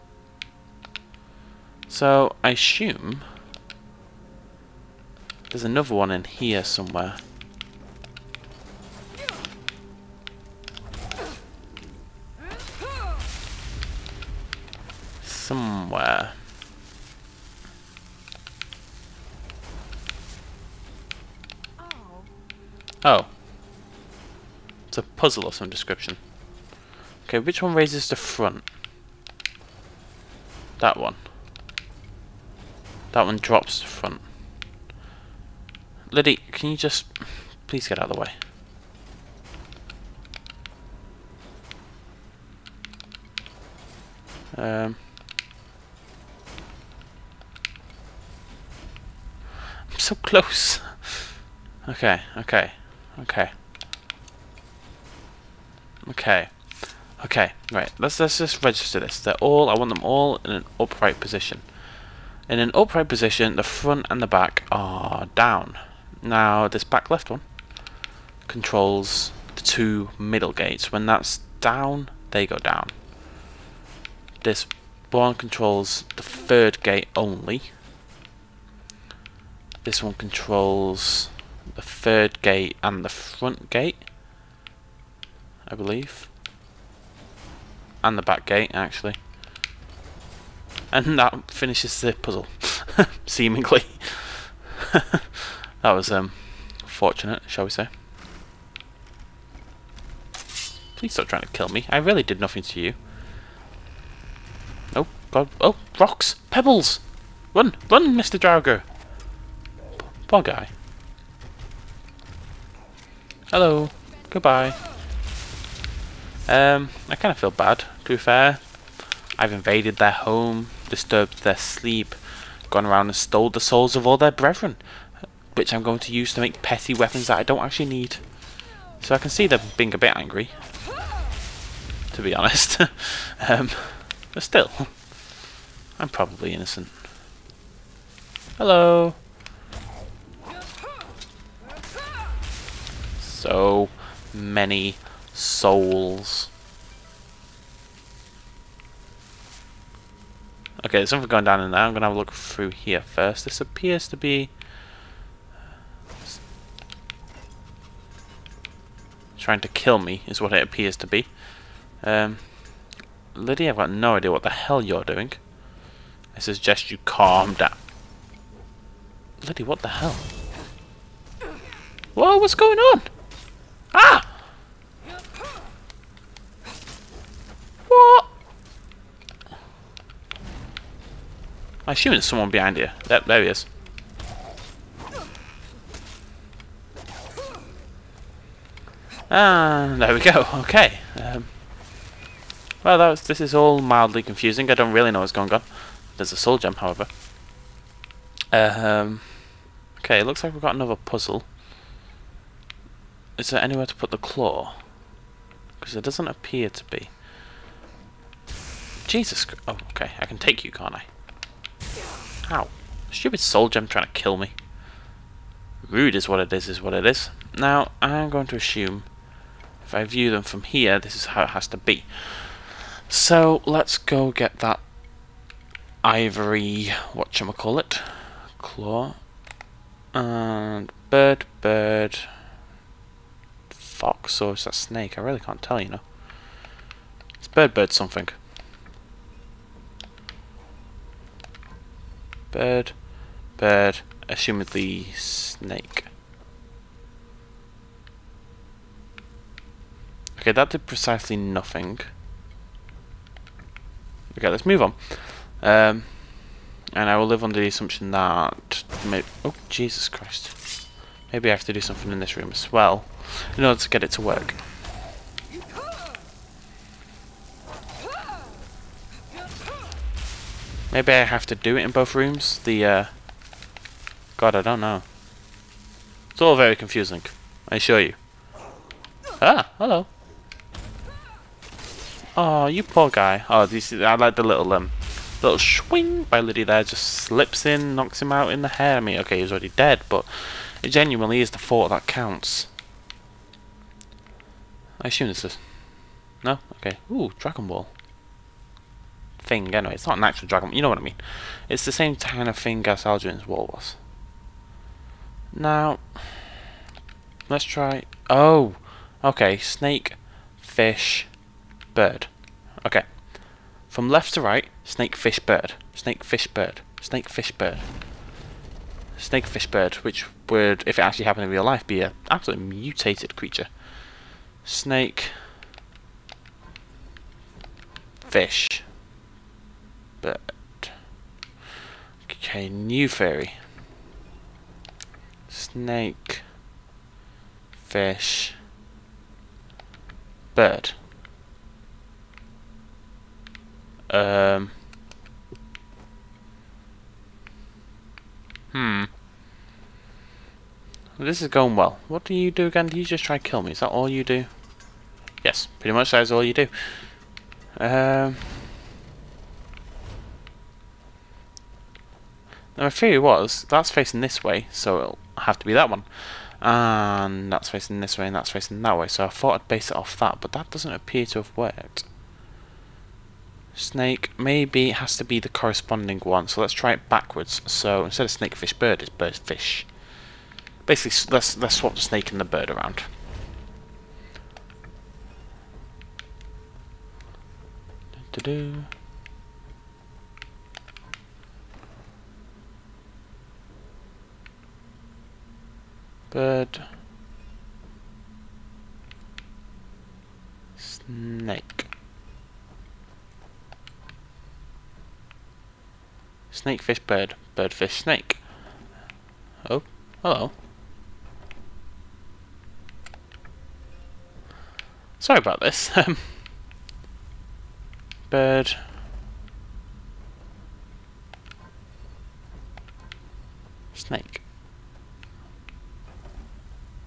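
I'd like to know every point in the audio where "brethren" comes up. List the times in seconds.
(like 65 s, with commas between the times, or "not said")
124 s.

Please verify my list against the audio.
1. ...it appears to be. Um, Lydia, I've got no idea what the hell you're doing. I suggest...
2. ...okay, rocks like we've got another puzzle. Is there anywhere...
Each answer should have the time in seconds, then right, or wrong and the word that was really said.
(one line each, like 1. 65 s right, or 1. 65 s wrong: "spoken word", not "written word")
1. 160 s right
2. 199 s wrong: "looks", not "rocks".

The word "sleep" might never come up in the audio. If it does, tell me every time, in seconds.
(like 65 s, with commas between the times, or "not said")
121 s.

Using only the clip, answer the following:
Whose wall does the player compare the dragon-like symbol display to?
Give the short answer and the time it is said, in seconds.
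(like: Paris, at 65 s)
Algerin, at 303 s.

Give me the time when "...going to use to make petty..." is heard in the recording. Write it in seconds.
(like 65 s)
125 s.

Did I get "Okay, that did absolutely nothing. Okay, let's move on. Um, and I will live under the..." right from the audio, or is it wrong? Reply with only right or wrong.
wrong.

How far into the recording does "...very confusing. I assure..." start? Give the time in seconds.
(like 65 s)
276 s.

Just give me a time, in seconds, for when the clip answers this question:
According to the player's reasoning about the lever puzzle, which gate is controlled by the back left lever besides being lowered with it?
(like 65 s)
69 s.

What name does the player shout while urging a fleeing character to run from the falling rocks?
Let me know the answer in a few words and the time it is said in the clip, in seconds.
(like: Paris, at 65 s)
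Mr. Drago, at 108 s.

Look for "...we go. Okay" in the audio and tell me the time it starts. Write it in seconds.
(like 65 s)
190 s.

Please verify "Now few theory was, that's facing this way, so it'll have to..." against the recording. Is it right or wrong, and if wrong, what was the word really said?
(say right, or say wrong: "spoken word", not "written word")
right.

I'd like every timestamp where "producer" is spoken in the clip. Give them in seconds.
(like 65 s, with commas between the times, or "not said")
not said.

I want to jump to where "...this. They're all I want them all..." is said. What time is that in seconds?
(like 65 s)
58 s.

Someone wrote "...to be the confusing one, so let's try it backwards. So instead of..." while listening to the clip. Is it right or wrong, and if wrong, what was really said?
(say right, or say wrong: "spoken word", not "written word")
wrong: "corresponding", not "confusing".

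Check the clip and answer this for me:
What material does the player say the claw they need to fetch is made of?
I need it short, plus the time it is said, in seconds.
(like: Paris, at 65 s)
ivory, at 226 s.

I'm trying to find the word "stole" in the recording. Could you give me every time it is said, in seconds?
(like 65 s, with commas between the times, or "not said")
123 s.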